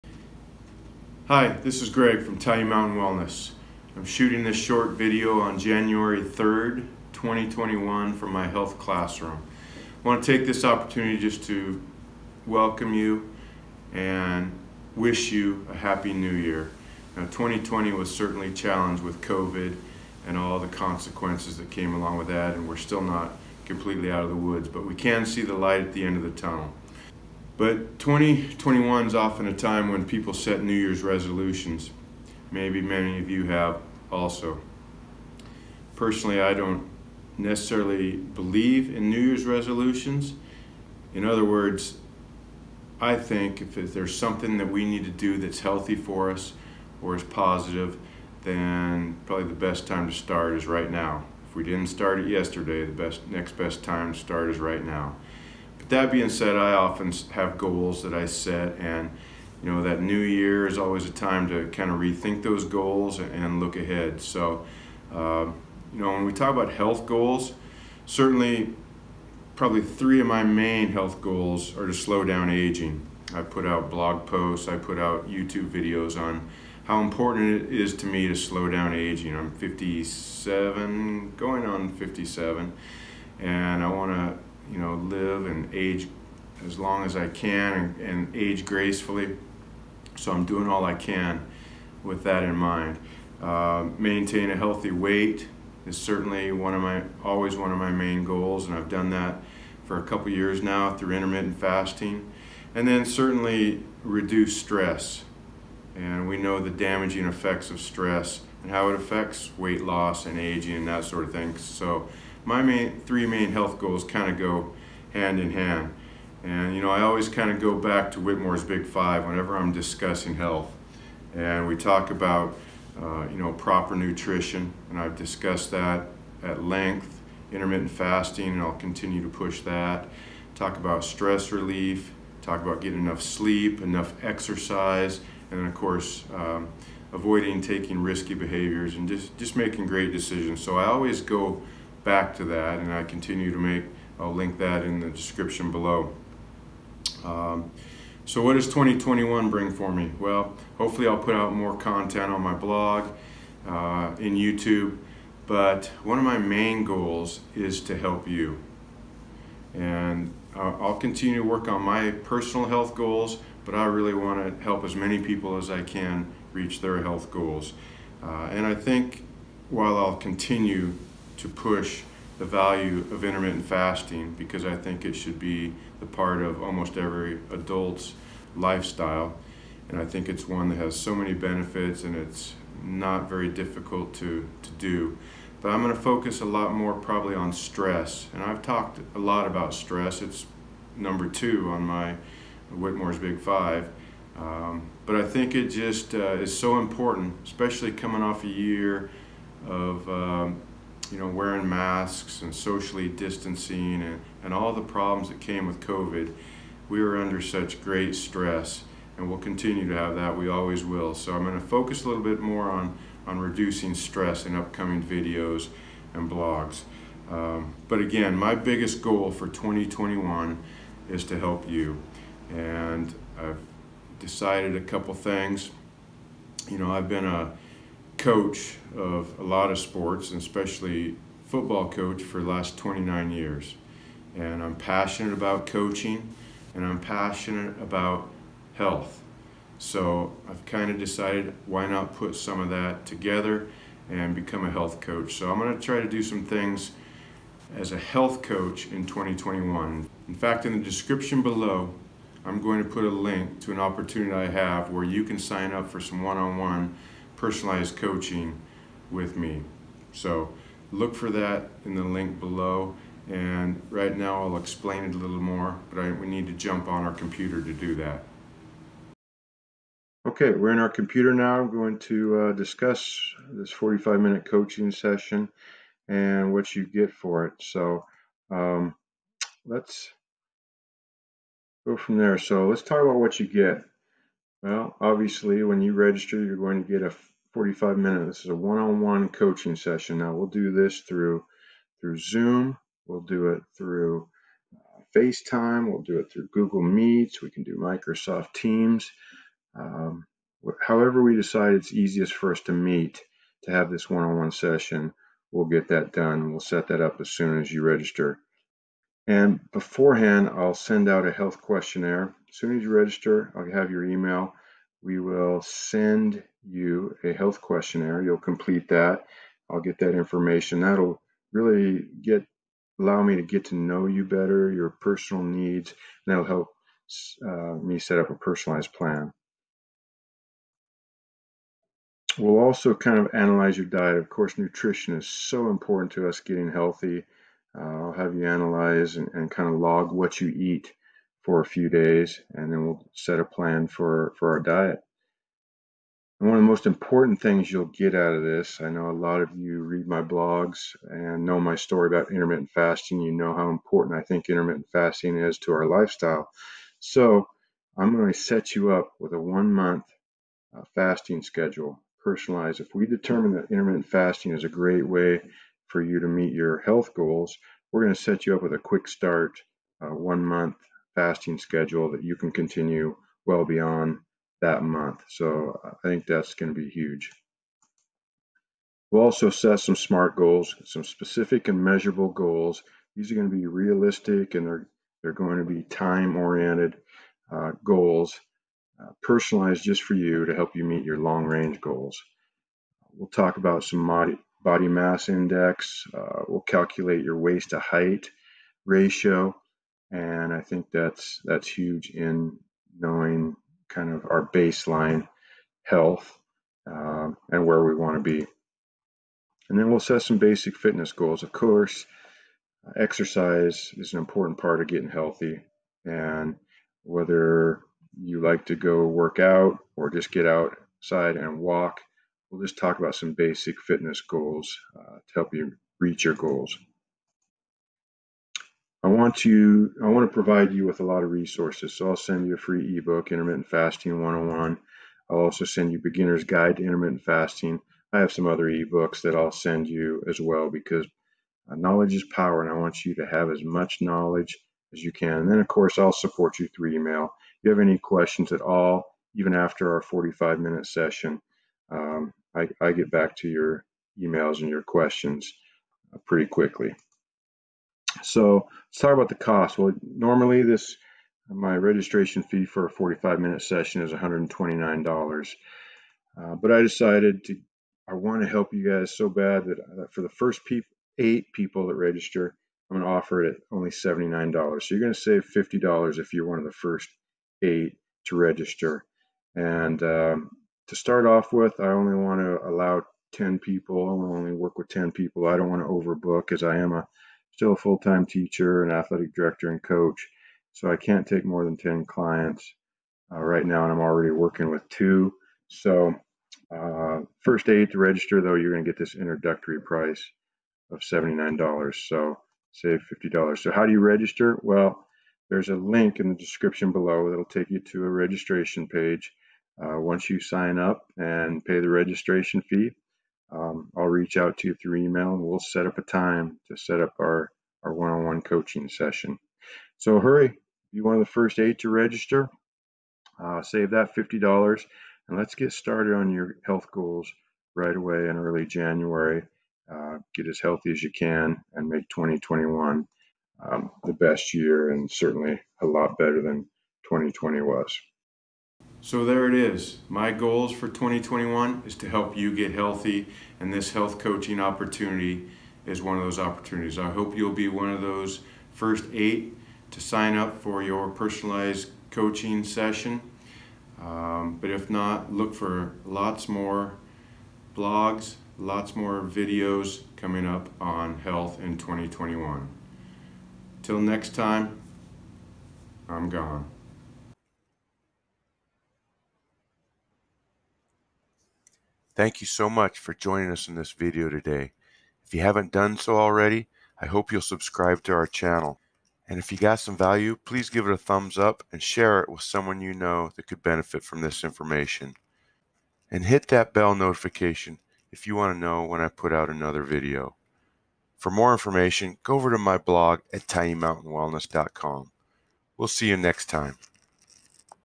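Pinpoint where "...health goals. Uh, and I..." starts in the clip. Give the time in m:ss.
2:47.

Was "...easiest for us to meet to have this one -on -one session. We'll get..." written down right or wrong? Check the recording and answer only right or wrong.
right.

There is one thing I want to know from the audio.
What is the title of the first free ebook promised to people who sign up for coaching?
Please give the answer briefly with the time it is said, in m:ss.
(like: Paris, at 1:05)
Intermittent Fasting 101, at 7:13.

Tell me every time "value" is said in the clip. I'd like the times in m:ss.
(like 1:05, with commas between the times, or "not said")
2:52, 9:39.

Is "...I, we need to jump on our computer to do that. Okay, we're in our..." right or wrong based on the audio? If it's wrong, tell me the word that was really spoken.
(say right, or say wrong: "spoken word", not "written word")
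right.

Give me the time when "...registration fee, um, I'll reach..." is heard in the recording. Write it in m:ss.
8:31.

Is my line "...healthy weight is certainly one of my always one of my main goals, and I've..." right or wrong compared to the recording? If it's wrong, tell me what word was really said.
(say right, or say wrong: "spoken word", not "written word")
right.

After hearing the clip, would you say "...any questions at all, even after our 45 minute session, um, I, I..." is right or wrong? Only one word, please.
right.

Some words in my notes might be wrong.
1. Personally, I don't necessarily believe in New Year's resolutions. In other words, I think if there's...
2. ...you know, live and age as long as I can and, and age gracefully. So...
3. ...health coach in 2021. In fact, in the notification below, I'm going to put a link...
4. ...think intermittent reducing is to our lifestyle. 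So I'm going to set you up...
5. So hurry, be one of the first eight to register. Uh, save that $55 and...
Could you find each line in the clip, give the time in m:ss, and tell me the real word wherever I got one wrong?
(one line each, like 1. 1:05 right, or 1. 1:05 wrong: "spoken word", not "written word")
1. 0:35 right
2. 1:24 right
3. 4:07 wrong: "description", not "notification"
4. 5:54 wrong: "fasting", not "reducing"
5. 8:39 wrong: "50", not "55".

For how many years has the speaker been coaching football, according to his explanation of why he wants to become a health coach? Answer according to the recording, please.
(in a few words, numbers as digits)
29.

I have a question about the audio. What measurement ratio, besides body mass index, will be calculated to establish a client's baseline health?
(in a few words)
Waist to height ratio.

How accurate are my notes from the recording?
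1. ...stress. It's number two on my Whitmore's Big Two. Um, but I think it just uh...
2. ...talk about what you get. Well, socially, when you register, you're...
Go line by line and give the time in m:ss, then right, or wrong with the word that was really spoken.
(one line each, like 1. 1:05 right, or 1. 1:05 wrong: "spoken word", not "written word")
1. 3:09 wrong: "Five", not "Two"
2. 4:42 wrong: "obviously", not "socially".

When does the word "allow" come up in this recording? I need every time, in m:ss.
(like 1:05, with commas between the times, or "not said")
5:22, 8:02.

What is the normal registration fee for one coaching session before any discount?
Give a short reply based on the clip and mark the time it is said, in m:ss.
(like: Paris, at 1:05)
$129, at 7:44.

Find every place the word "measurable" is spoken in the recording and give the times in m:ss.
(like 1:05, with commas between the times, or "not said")
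6:21.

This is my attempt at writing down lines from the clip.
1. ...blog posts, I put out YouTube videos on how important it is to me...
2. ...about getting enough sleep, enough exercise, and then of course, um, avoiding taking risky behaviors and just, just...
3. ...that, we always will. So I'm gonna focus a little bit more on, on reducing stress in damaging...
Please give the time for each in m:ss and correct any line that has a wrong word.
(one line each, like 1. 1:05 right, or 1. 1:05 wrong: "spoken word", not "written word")
1. 1:13 right
2. 2:12 right
3. 3:30 wrong: "upcoming", not "damaging".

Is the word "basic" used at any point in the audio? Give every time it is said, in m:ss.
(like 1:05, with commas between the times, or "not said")
6:50, 7:03.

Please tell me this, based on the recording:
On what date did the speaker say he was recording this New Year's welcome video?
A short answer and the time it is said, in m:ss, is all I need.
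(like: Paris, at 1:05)
January 3rd, 2021, at 0:05.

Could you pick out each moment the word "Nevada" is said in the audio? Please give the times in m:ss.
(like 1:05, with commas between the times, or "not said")
not said.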